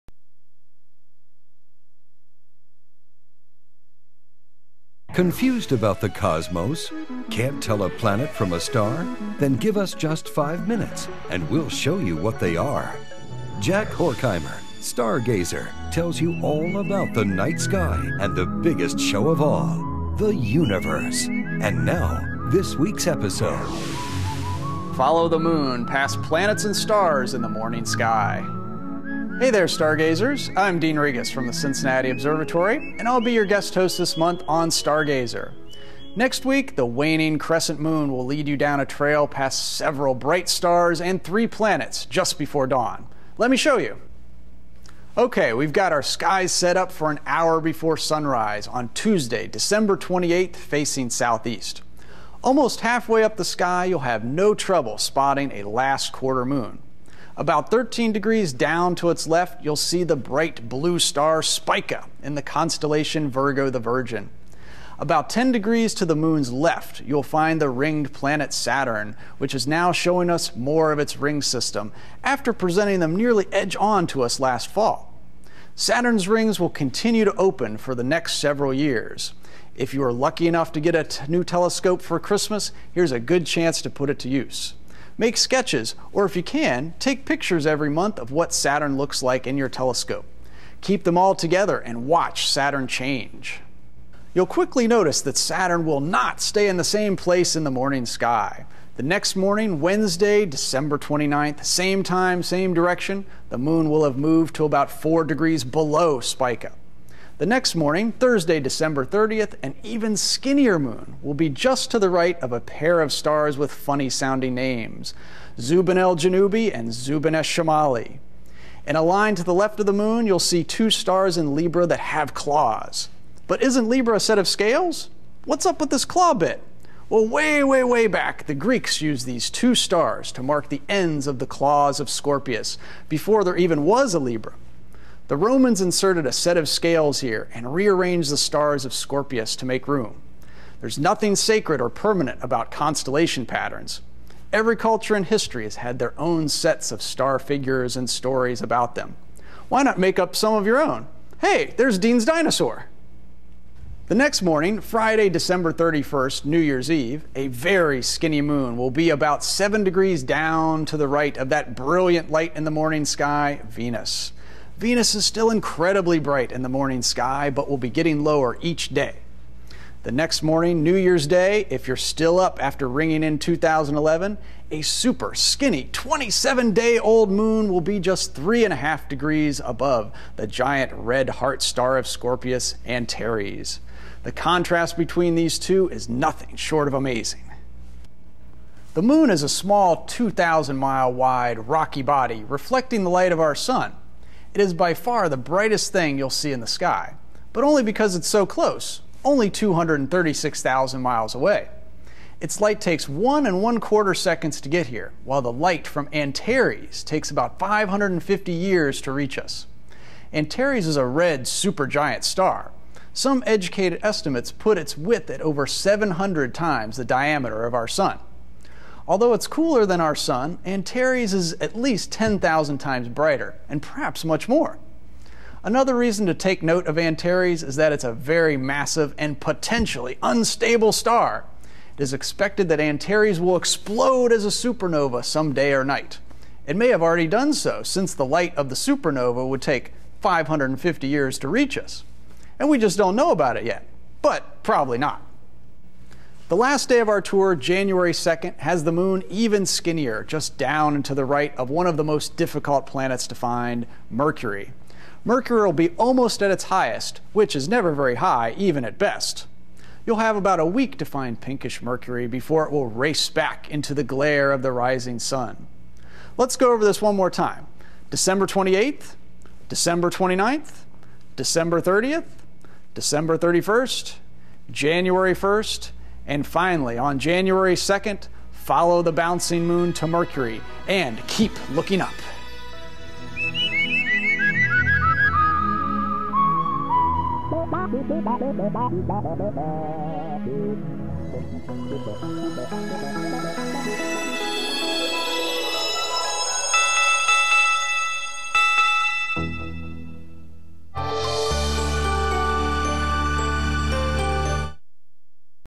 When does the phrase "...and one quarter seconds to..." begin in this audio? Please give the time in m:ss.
3:23.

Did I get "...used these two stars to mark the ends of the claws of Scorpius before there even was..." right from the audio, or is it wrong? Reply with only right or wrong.
right.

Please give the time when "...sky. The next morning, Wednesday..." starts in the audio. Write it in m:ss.
1:38.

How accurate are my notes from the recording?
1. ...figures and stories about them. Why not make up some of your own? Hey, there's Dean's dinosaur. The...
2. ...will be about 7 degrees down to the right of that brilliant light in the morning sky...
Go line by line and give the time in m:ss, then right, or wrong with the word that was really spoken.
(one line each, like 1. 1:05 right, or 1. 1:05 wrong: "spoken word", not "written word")
1. 2:27 right
2. 2:38 right.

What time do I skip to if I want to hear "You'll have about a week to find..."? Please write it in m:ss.
4:20.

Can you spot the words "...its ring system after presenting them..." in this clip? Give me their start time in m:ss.
1:10.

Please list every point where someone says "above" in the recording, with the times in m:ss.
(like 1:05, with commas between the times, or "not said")
2:59.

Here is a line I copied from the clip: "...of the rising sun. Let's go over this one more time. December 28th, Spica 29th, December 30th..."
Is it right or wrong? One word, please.
wrong.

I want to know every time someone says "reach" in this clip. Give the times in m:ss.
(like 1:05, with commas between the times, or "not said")
3:29, 4:01.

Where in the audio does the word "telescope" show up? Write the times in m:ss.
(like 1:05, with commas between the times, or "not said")
1:21, 1:29.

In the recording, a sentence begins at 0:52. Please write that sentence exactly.
Almost halfway up the sky, you'll have no trouble spotting a last quarter moon.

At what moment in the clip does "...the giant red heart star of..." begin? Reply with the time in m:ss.
3:00.